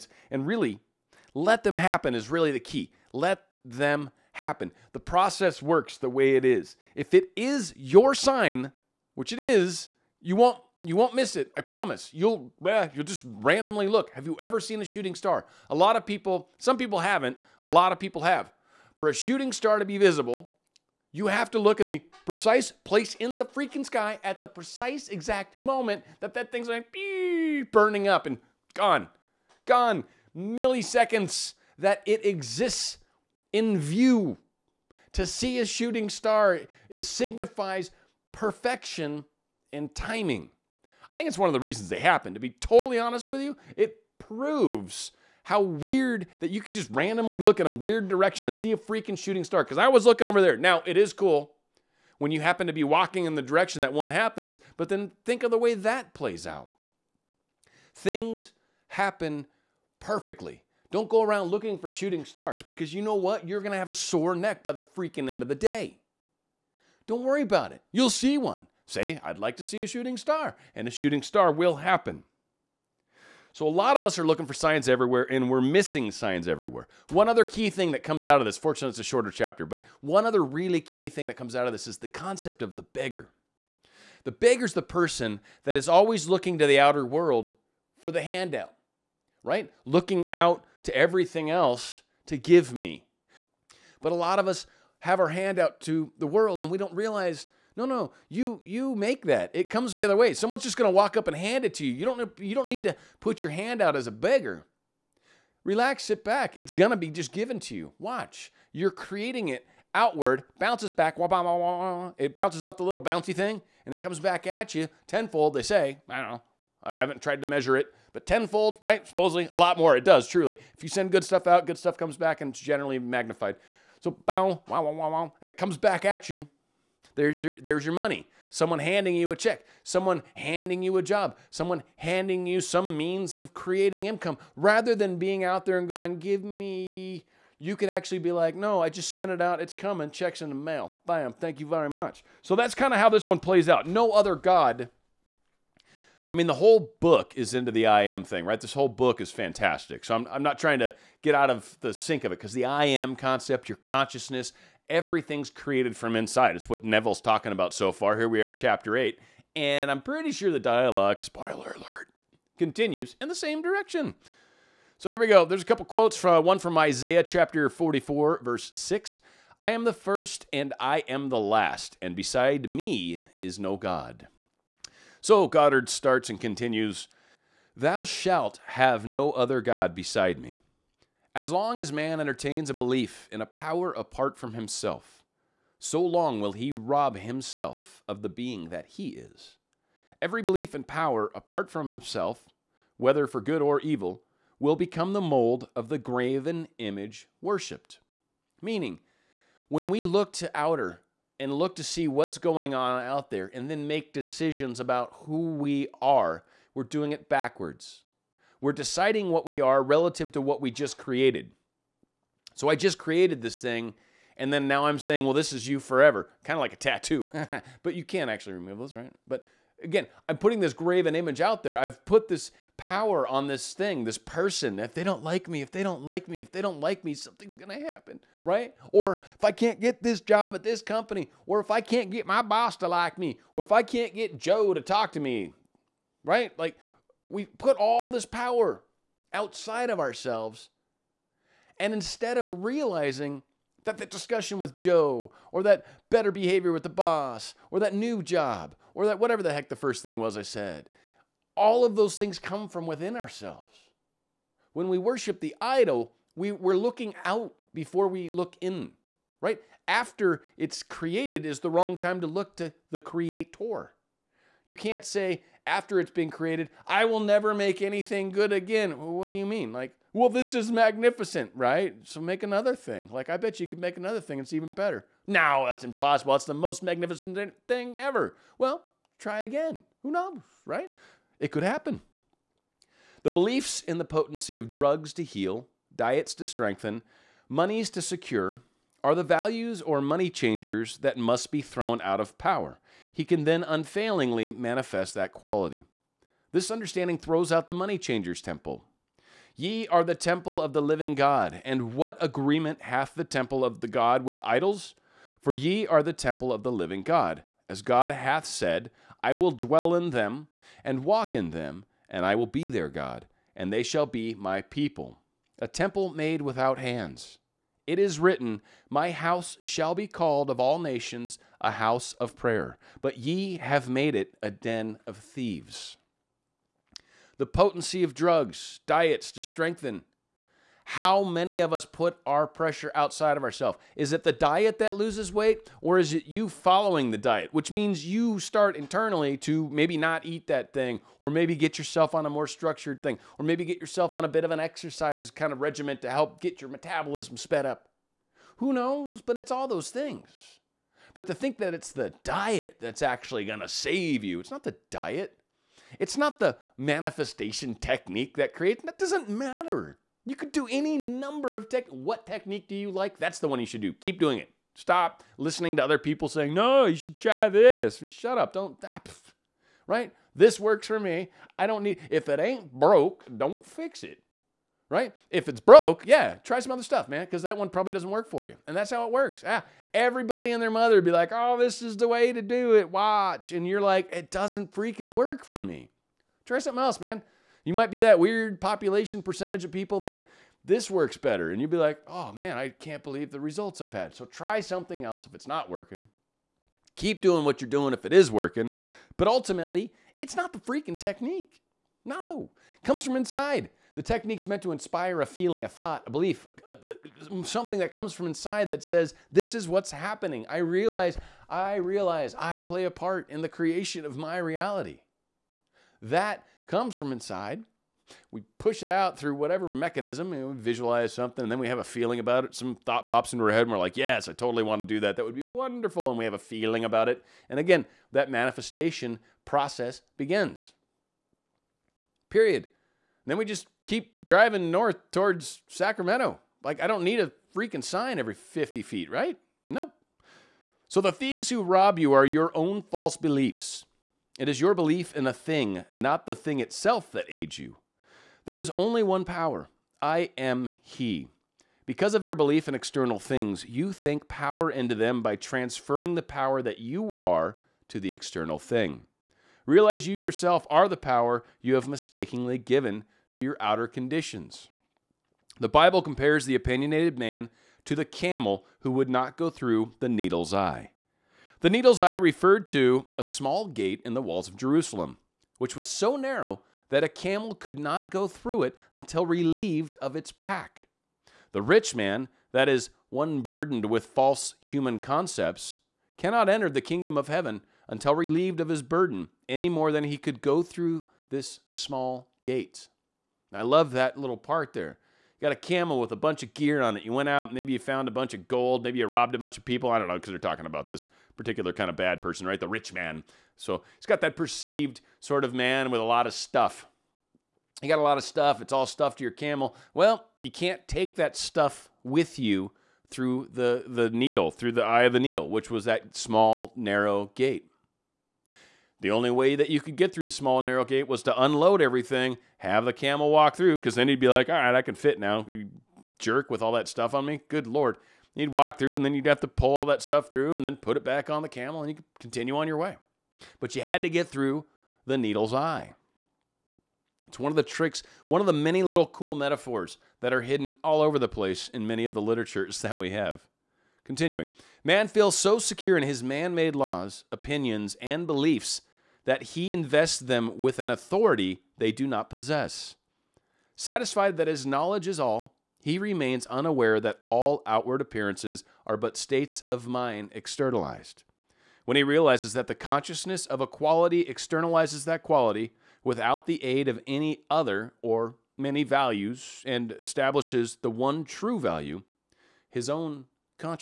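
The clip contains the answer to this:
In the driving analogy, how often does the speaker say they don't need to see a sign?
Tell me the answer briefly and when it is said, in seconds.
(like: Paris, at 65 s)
every 50 feet, at 438 s.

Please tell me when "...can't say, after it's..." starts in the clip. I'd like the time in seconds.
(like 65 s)
264 s.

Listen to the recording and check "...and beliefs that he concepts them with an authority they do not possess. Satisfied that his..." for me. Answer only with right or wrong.
wrong.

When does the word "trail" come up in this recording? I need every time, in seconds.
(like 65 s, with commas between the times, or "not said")
not said.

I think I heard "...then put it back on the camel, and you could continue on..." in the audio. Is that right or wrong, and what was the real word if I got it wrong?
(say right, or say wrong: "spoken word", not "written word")
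right.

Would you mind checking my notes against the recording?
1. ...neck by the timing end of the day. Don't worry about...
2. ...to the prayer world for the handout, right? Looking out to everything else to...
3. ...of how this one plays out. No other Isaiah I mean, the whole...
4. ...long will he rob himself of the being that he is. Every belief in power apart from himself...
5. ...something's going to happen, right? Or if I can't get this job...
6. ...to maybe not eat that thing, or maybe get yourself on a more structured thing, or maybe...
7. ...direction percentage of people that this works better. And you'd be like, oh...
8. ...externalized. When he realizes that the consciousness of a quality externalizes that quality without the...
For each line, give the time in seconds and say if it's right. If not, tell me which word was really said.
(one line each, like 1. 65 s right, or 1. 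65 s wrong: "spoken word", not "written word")
1. 64 s wrong: "freaking", not "timing"
2. 86 s wrong: "outer", not "prayer"
3. 142 s wrong: "God", not "Isaiah"
4. 186 s right
5. 227 s right
6. 339 s right
7. 388 s wrong: "population", not "direction"
8. 560 s right.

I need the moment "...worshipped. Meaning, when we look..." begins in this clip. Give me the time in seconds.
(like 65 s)
197 s.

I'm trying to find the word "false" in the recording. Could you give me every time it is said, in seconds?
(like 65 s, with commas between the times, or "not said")
442 s, 484 s.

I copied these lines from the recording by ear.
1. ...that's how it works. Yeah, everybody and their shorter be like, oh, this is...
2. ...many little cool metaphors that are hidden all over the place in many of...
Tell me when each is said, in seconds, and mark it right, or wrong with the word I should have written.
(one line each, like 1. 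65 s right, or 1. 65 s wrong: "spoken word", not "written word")
1. 378 s wrong: "mother", not "shorter"
2. 538 s right.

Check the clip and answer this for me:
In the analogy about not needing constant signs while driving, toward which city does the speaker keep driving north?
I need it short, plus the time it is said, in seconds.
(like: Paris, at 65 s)
Sacramento, at 435 s.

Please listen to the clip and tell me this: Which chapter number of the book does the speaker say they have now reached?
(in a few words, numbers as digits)
8.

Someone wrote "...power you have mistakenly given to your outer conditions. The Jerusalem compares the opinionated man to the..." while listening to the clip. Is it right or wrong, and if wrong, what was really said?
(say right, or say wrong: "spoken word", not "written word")
wrong: "Bible", not "Jerusalem".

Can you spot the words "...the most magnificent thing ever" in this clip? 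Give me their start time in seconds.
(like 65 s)
276 s.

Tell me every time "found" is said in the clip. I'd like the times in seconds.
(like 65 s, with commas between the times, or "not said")
497 s.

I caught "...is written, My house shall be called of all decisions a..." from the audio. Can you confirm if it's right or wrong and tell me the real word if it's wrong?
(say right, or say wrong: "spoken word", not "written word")
wrong: "nations", not "decisions".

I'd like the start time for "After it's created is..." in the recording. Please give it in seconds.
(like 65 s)
259 s.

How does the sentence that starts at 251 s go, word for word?
All of those things come from within ourselves.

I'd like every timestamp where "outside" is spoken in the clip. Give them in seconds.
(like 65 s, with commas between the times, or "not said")
239 s, 332 s.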